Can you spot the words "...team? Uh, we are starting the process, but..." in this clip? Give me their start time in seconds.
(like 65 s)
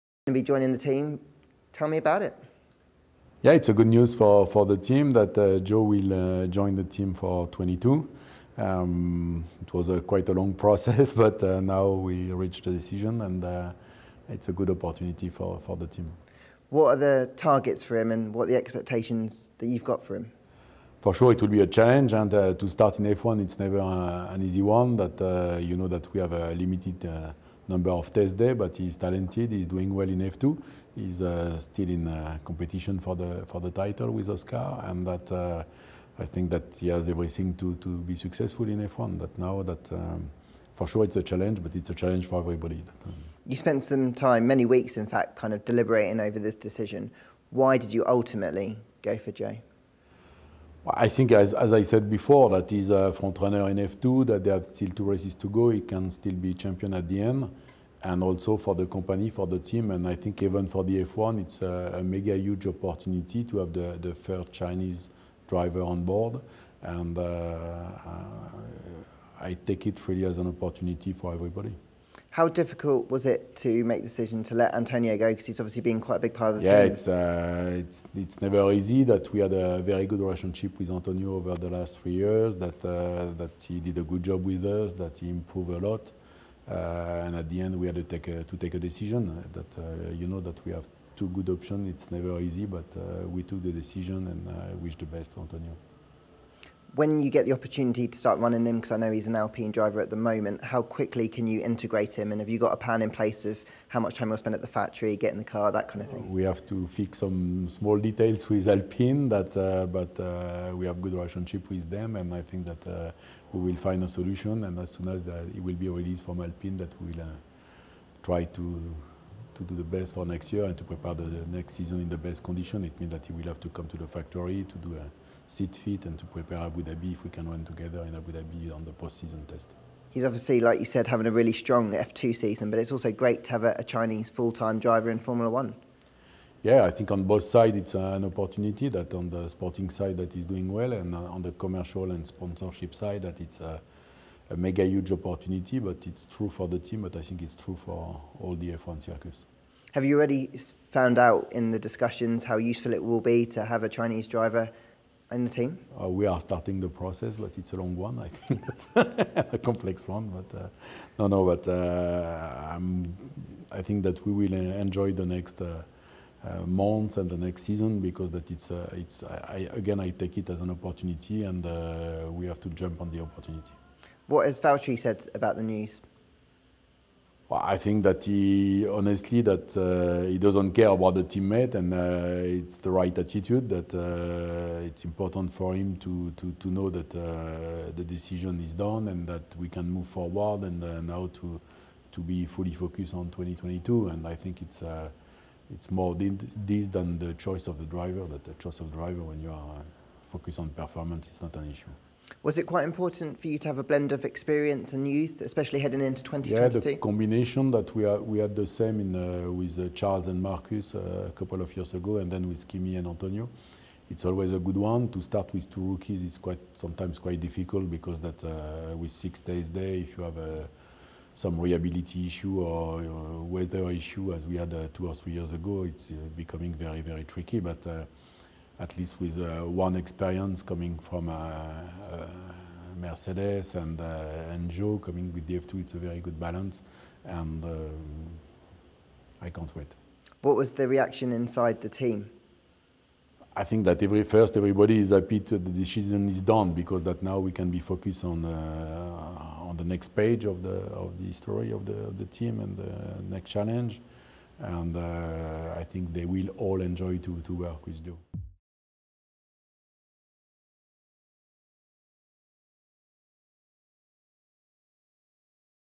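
155 s.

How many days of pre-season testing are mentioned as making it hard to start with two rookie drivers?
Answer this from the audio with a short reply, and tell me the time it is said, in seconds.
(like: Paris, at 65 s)
6, at 219 s.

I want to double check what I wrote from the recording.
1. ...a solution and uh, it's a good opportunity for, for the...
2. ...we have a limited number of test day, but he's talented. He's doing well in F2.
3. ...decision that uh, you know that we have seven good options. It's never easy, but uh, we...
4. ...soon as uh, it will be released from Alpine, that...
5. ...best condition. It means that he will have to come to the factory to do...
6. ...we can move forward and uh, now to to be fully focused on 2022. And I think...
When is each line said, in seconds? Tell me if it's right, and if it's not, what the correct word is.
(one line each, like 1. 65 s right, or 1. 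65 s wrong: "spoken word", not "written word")
1. 12 s wrong: "decision", not "solution"
2. 26 s right
3. 88 s wrong: "two", not "seven"
4. 114 s right
5. 122 s right
6. 189 s right.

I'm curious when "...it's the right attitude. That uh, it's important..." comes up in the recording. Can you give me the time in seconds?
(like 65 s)
182 s.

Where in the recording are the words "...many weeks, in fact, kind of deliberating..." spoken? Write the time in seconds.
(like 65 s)
44 s.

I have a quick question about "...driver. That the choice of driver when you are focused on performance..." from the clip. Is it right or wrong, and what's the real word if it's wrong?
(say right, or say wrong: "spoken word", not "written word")
right.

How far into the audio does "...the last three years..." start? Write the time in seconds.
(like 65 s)
81 s.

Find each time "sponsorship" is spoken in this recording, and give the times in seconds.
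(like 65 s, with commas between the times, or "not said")
142 s.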